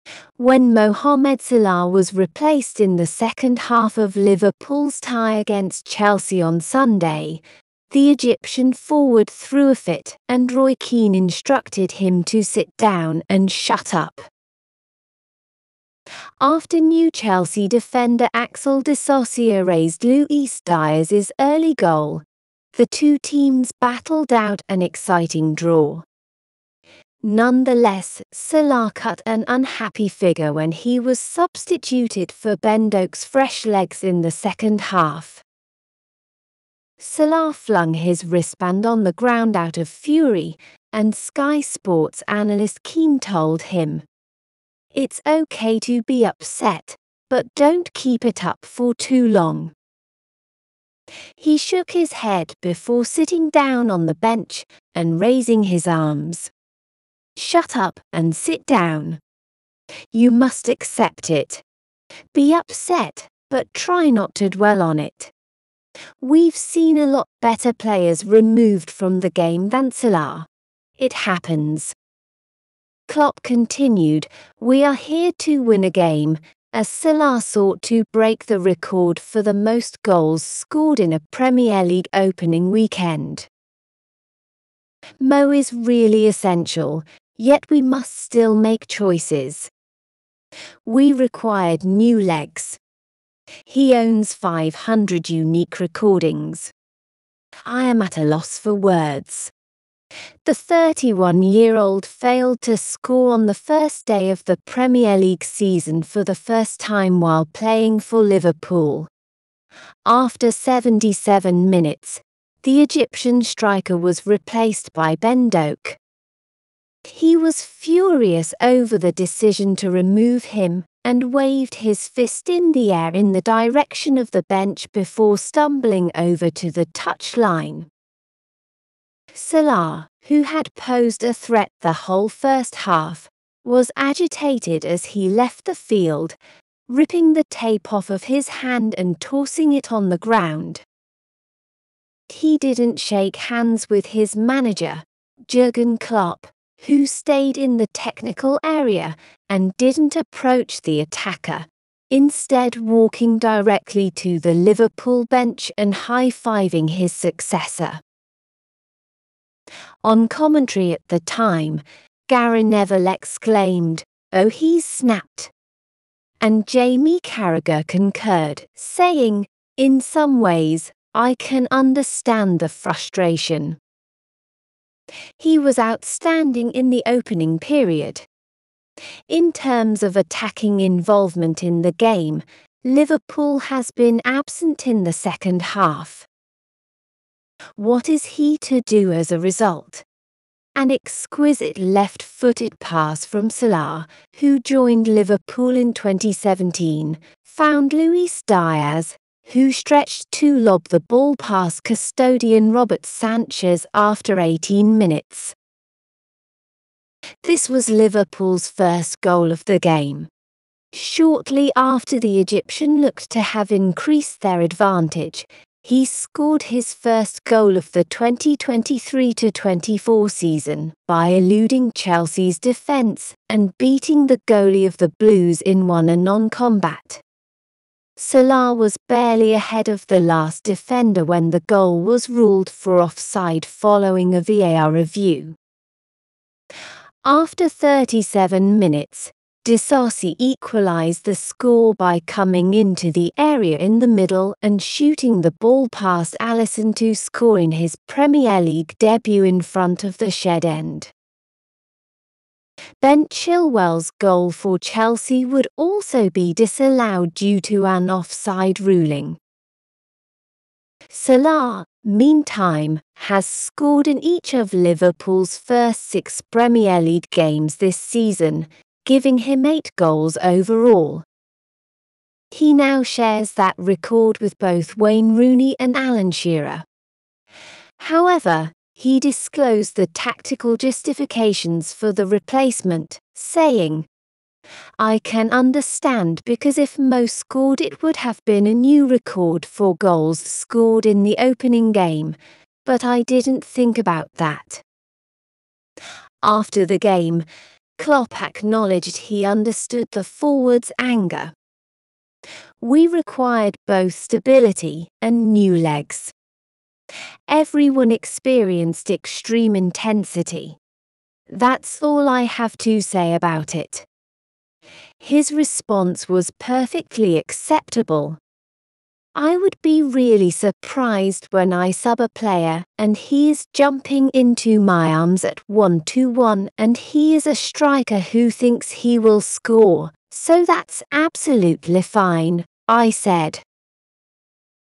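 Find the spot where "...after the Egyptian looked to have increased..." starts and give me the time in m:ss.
3:31.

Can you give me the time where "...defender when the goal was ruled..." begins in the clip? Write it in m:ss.
3:50.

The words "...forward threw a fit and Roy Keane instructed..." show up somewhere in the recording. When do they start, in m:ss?
0:08.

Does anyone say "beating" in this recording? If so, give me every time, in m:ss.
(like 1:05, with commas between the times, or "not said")
3:43.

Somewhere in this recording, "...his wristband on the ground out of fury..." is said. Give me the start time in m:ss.
0:37.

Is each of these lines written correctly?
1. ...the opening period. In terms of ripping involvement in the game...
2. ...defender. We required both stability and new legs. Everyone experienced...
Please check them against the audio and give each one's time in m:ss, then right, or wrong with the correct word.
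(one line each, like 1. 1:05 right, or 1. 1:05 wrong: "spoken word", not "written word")
1. 2:56 wrong: "attacking", not "ripping"
2. 5:00 wrong: "anger", not "defender".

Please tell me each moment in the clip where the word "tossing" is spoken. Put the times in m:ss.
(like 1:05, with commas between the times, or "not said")
2:19.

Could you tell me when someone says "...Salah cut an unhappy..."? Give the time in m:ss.
0:28.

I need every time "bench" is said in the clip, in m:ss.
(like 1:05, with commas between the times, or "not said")
0:54, 2:04, 2:35.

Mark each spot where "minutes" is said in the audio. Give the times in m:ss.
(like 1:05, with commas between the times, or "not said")
1:51, 3:24, 3:58.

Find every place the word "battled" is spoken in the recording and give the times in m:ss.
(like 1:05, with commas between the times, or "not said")
0:23.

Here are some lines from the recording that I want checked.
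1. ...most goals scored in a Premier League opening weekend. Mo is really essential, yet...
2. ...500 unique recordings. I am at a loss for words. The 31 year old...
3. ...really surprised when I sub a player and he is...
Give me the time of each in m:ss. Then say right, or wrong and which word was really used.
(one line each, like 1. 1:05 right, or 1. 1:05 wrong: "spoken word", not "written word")
1. 1:19 right
2. 1:34 right
3. 5:20 right.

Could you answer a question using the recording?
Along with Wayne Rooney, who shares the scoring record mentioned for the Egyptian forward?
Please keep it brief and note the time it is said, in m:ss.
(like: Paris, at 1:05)
Alan Shearer, at 4:35.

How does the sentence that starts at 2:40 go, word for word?
On commentary at the time, Gary Neville exclaimed, Oh, he's snapped.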